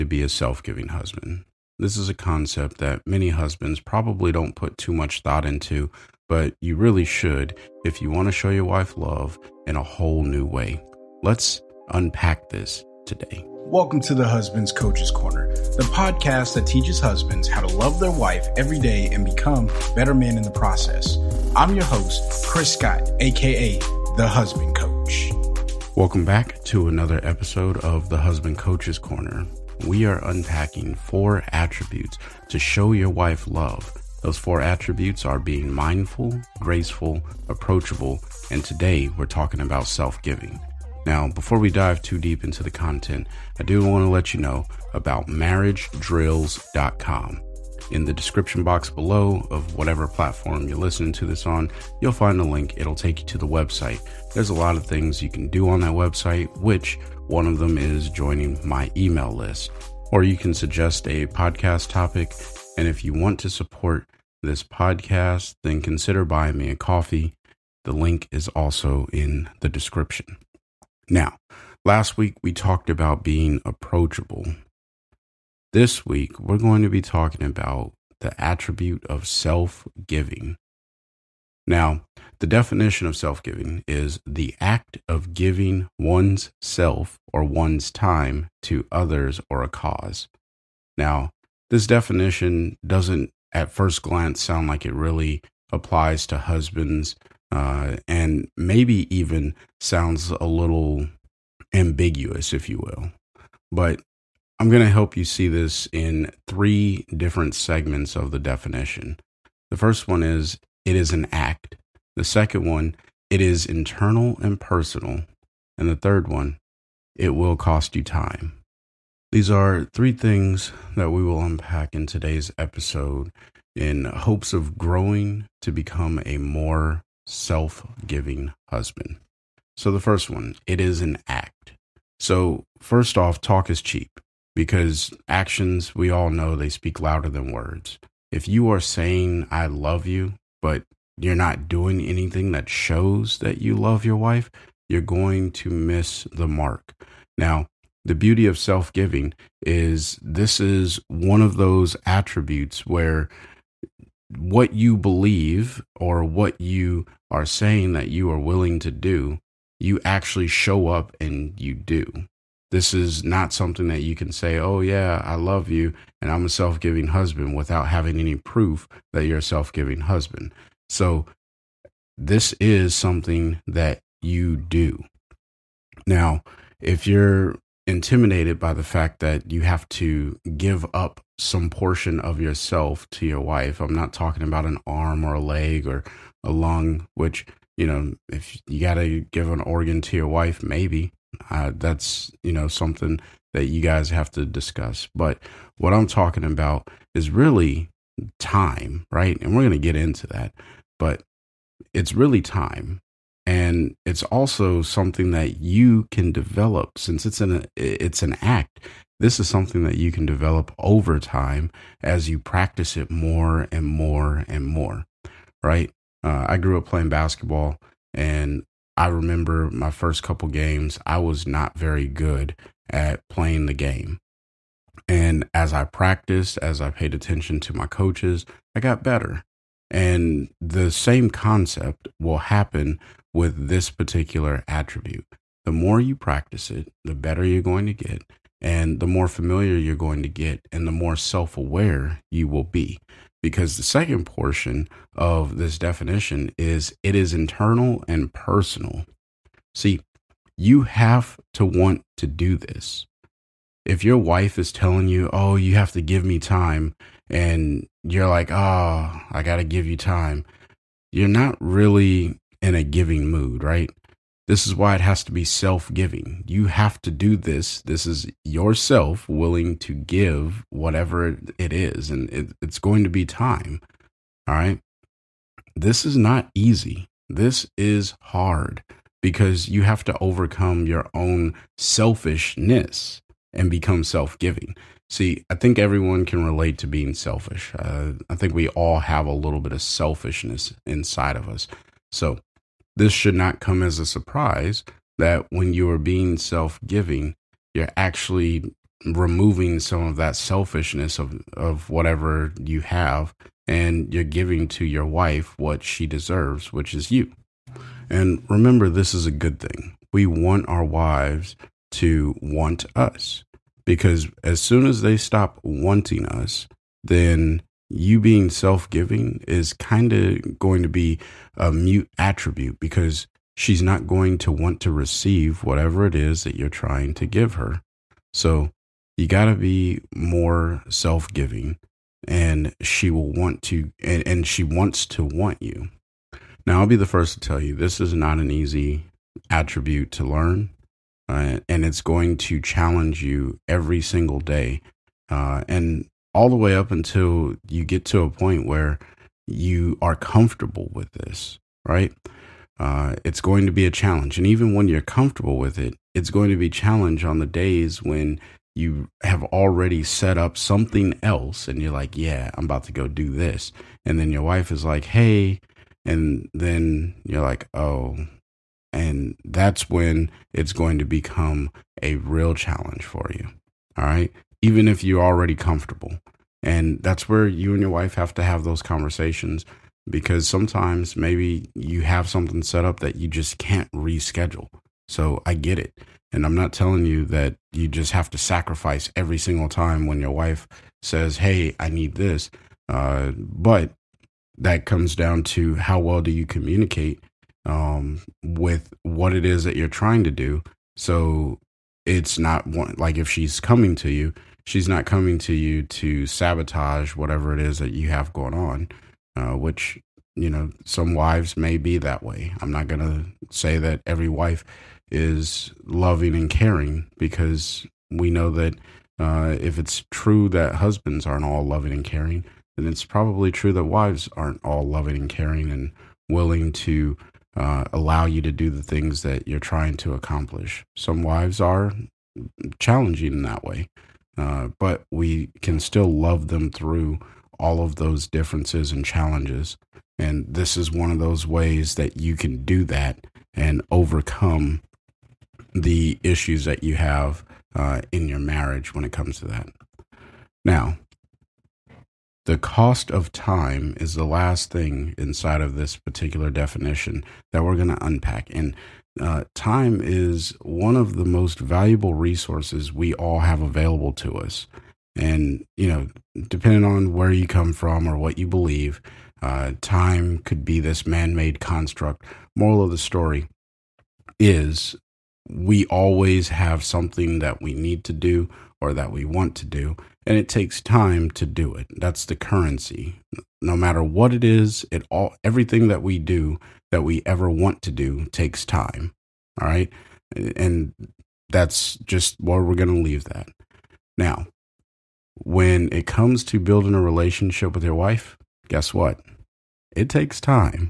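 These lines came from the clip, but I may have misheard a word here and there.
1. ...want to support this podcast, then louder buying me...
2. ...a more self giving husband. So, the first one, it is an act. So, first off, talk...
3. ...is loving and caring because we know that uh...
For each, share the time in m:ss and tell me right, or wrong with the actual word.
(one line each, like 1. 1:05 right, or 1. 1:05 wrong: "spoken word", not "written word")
1. 1:03 wrong: "consider", not "louder"
2. 2:06 right
3. 6:55 right.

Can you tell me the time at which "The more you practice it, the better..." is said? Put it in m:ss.
3:55.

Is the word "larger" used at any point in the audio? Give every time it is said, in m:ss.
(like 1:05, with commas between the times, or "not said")
not said.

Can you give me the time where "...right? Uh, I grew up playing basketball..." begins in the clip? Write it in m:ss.
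3:35.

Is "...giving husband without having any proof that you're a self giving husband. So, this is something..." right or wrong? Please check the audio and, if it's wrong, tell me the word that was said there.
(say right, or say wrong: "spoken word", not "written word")
right.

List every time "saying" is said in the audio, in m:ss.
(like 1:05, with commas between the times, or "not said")
2:18, 2:37.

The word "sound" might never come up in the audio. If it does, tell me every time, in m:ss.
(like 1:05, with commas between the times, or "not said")
1:34, 1:39.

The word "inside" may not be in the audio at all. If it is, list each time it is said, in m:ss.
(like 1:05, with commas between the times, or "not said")
4:50, 7:35.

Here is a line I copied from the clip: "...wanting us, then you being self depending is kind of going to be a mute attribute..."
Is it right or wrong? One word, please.
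wrong.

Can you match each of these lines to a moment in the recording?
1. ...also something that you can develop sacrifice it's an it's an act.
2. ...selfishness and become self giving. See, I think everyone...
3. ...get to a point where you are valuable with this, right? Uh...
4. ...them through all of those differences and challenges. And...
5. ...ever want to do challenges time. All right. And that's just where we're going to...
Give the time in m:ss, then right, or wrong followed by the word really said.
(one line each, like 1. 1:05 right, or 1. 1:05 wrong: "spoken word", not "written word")
1. 3:24 wrong: "since", not "sacrifice"
2. 4:41 right
3. 5:47 wrong: "comfortable", not "valuable"
4. 7:16 right
5. 8:07 wrong: "takes", not "challenges".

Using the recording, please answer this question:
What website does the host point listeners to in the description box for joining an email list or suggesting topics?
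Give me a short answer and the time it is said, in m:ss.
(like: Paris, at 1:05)
marriagedrills.com, at 0:45.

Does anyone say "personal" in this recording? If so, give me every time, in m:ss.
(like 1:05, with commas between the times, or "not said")
1:54, 4:08.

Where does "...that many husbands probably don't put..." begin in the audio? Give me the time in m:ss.
0:02.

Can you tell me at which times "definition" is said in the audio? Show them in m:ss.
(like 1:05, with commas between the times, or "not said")
1:22, 1:31, 1:48, 4:05, 7:36.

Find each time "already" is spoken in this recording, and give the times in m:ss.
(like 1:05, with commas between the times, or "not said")
5:59, 6:15.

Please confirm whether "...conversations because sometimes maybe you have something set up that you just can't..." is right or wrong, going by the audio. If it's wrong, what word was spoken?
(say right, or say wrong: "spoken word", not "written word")
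right.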